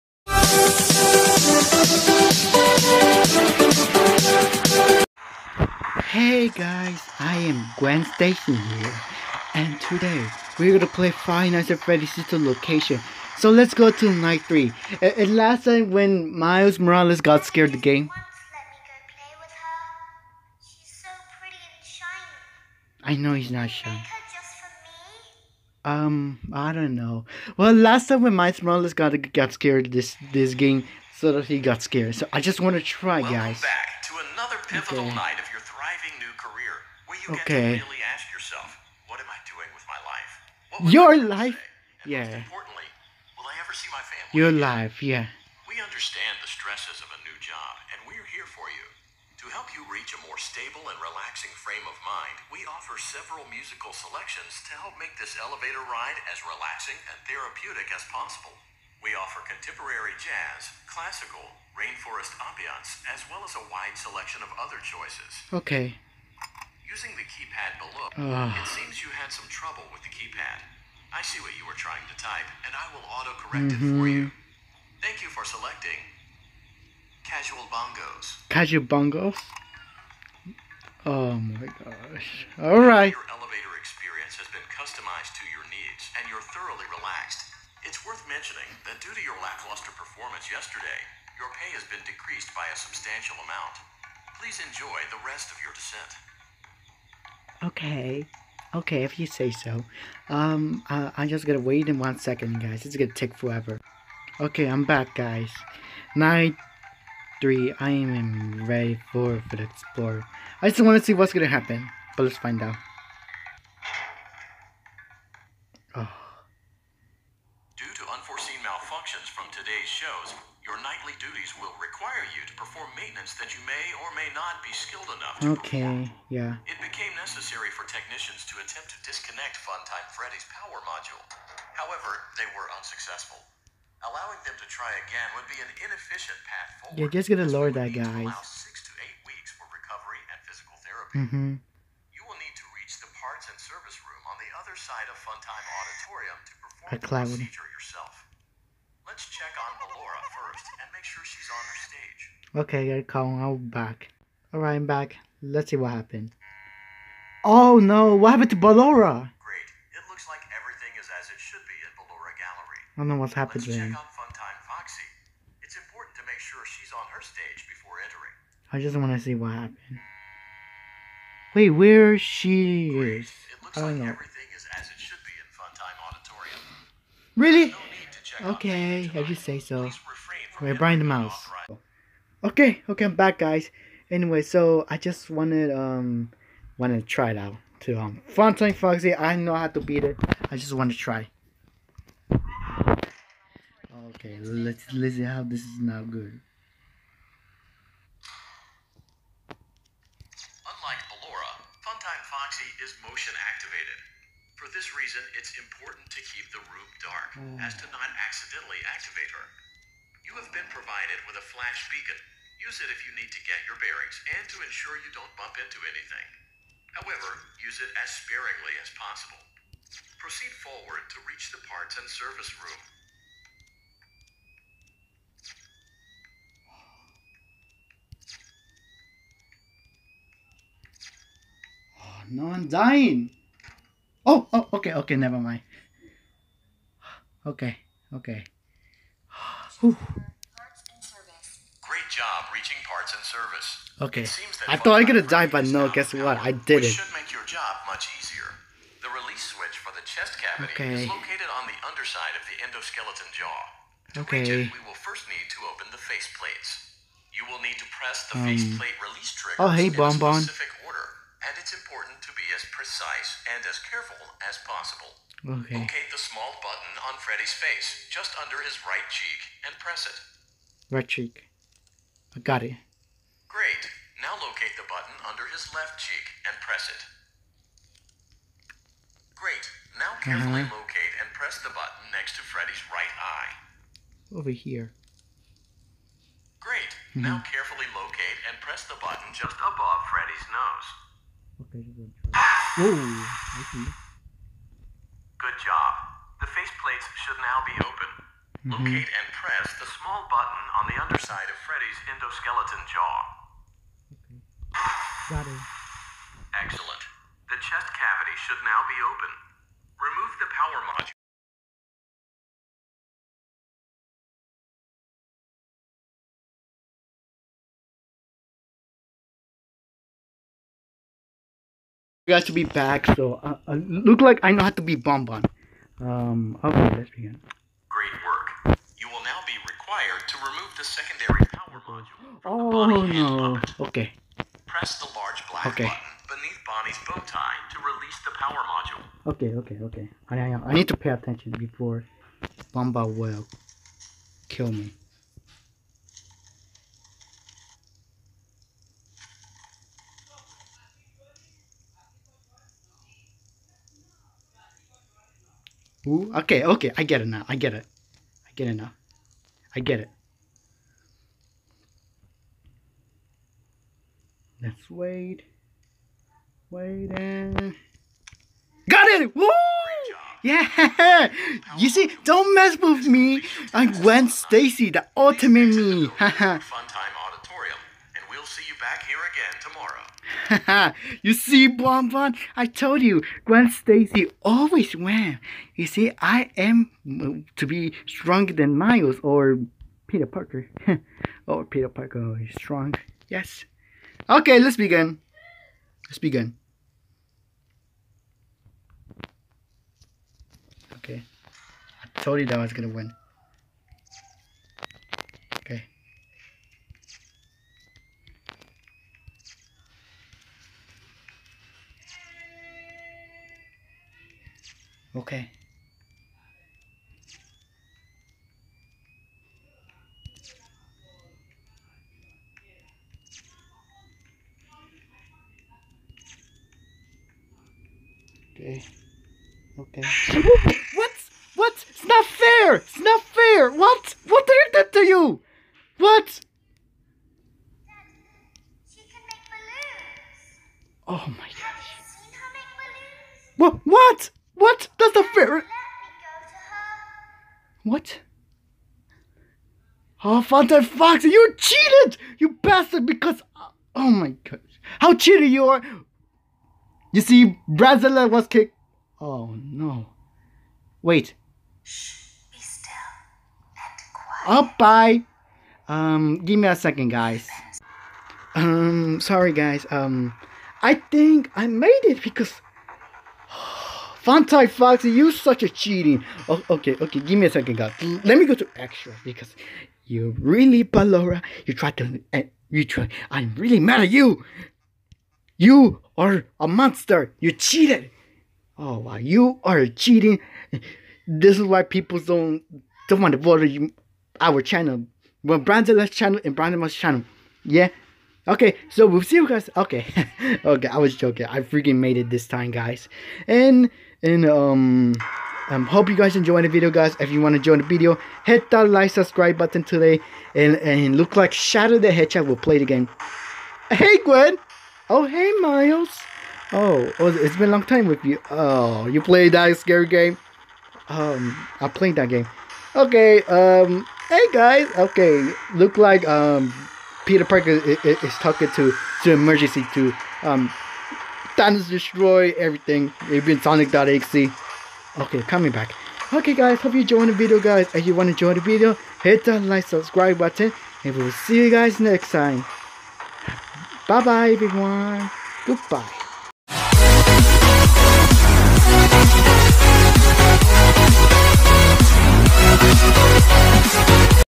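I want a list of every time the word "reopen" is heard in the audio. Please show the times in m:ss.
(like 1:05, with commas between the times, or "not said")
not said.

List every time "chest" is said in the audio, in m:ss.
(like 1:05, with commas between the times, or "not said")
4:10, 5:07.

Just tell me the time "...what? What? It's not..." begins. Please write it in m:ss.
7:10.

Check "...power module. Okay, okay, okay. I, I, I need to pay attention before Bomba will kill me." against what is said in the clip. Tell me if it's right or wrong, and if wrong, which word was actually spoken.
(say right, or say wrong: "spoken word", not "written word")
right.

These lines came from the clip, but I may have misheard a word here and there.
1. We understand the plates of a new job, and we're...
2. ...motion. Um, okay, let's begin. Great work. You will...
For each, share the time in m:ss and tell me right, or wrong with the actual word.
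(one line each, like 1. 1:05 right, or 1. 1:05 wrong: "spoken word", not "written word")
1. 0:45 wrong: "stresses", not "plates"
2. 5:24 wrong: "bonbon", not "motion".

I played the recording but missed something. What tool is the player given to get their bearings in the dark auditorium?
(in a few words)
Flash beacon.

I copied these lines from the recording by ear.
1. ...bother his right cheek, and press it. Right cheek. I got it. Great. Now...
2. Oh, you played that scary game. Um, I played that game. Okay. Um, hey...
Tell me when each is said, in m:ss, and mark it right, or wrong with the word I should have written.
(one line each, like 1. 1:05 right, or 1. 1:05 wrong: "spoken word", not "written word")
1. 4:28 wrong: "under", not "bother"
2. 8:38 right.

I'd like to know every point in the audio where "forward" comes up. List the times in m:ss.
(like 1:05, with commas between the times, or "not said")
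2:16, 3:40.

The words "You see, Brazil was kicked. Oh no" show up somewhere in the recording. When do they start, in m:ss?
7:37.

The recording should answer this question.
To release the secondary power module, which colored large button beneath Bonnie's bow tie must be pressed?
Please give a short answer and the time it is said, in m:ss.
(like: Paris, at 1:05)
Black, at 5:35.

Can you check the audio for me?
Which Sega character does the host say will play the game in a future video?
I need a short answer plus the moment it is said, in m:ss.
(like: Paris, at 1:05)
Shadow the Hedgehog, at 8:31.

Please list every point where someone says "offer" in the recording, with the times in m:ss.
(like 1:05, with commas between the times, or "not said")
0:52, 0:59.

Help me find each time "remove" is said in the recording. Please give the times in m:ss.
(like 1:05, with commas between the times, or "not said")
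5:09, 5:30.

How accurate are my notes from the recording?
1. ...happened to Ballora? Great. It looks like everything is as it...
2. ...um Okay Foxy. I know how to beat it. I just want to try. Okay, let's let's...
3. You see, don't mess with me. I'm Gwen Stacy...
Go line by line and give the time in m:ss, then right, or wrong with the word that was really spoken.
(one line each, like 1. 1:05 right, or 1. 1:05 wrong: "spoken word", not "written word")
1. 2:38 right
2. 3:07 wrong: "Funtime", not "Okay"
3. 6:11 right.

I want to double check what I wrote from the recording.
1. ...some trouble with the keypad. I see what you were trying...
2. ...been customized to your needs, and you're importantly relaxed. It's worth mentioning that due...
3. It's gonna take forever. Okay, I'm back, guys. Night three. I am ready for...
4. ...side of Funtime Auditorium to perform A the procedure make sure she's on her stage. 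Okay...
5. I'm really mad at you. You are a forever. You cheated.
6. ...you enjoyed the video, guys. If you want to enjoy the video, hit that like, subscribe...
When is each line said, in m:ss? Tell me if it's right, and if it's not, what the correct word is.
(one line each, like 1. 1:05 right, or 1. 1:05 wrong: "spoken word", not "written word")
1. 1:09 right
2. 1:24 wrong: "thoroughly", not "importantly"
3. 1:42 right
4. 2:24 right
5. 8:03 wrong: "monster", not "forever"
6. 8:56 right.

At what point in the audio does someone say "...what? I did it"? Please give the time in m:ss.
4:06.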